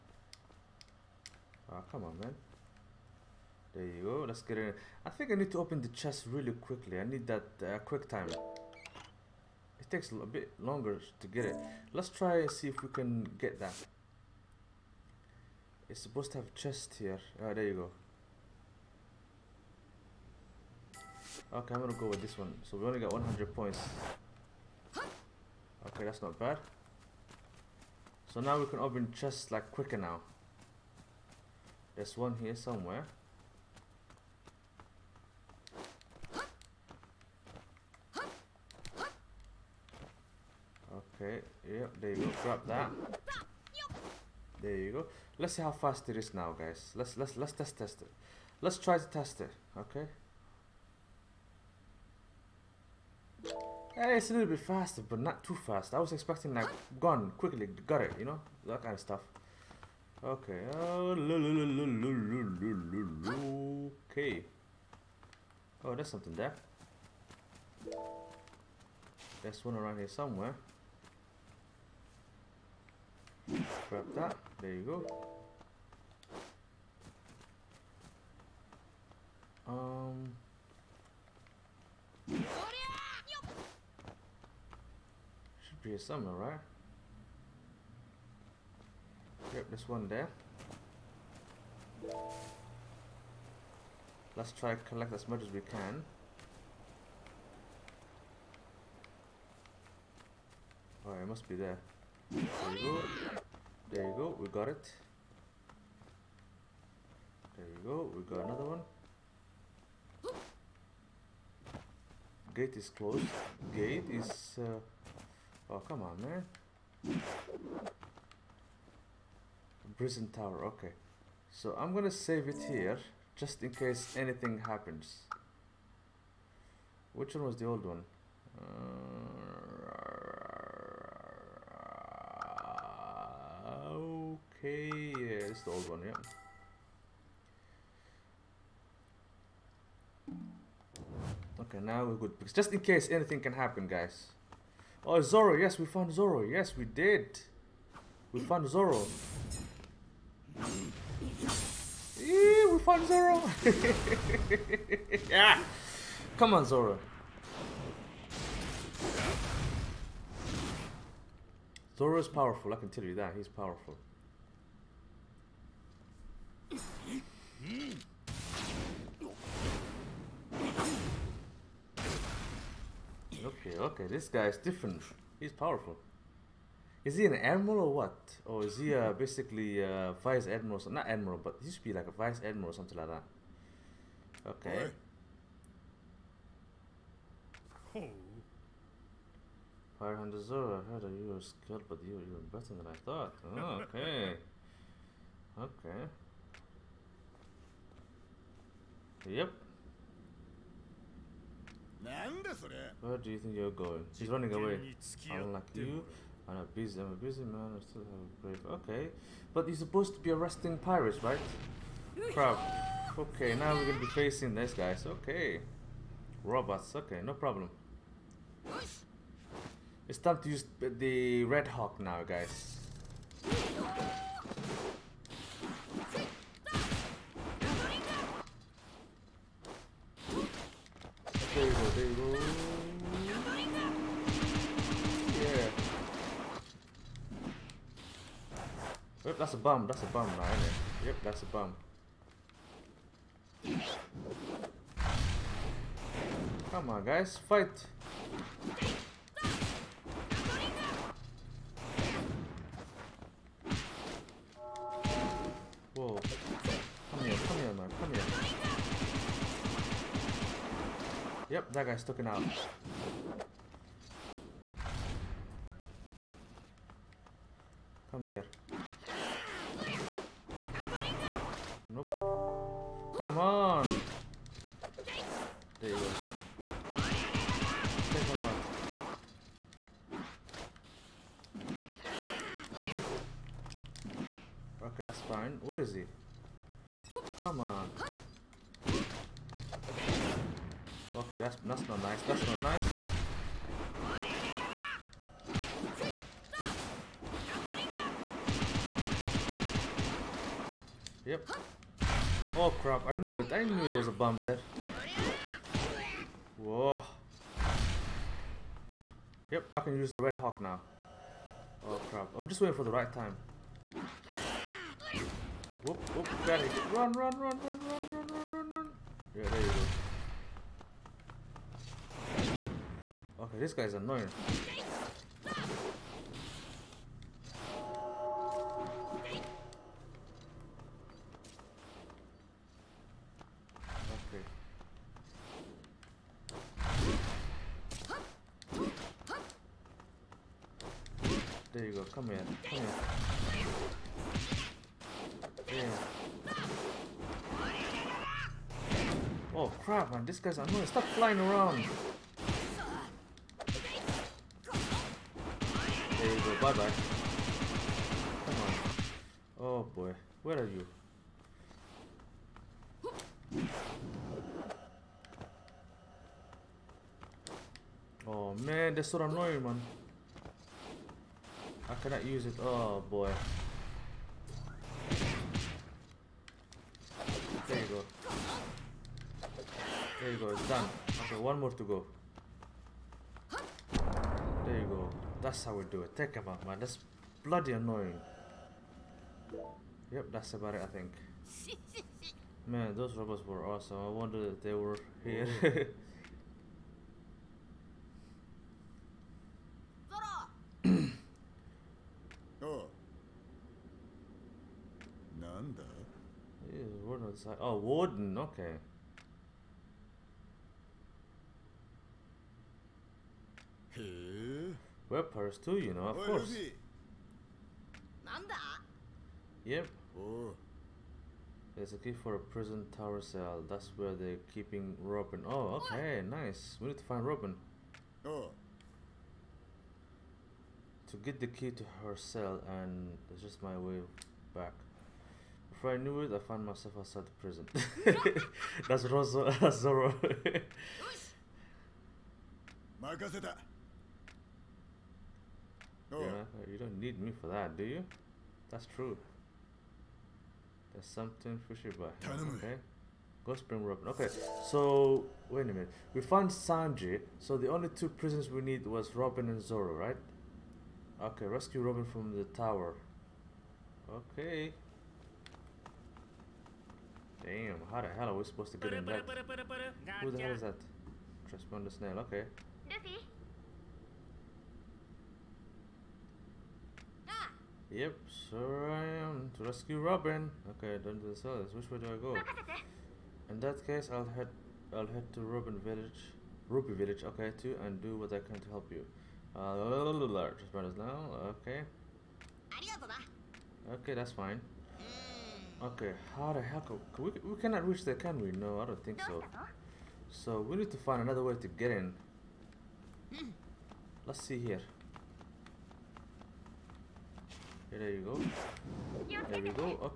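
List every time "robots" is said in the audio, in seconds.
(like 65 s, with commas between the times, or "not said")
216 s, 393 s.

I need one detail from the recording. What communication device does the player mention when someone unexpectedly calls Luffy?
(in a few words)
Transponder snail.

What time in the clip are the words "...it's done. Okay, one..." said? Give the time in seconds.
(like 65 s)
380 s.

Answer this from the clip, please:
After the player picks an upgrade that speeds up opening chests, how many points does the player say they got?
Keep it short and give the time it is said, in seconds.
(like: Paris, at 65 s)
100, at 23 s.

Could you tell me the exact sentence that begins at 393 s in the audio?
I wonder if they were here.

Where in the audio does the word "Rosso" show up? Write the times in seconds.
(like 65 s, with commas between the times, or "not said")
439 s.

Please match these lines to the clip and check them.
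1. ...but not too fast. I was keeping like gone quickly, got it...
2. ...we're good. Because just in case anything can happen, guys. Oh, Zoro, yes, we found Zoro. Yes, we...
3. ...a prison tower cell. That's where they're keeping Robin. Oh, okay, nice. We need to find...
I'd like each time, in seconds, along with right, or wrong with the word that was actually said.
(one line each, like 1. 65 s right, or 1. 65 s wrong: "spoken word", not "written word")
1. 55 s wrong: "expecting", not "keeping"
2. 142 s right
3. 422 s right.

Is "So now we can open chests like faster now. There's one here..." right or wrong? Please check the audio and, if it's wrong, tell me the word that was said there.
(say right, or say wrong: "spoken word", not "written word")
wrong: "quicker", not "faster".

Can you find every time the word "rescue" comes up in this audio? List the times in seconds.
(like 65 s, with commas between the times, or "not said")
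461 s, 479 s.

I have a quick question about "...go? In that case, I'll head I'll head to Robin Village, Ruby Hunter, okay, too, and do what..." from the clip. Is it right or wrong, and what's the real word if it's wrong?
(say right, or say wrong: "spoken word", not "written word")
wrong: "Village", not "Hunter".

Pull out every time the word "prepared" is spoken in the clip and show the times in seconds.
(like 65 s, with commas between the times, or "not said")
not said.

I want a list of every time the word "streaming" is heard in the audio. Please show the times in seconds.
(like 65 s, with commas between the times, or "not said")
not said.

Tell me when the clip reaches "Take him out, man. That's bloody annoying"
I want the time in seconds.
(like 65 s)
386 s.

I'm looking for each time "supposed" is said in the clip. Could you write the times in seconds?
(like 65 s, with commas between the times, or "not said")
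16 s, 209 s, 468 s.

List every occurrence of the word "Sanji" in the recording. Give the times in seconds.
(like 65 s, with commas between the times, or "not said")
456 s.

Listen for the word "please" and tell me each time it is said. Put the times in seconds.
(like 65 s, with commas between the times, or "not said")
not said.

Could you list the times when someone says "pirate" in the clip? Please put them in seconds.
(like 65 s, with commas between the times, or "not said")
189 s, 210 s.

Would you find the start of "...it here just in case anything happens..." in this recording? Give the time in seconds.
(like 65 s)
122 s.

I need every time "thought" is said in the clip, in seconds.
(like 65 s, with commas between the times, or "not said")
193 s.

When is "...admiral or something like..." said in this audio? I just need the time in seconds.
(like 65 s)
182 s.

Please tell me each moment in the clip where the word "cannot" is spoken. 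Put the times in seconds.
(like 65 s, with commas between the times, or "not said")
372 s, 497 s.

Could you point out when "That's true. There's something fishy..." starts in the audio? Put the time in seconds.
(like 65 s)
448 s.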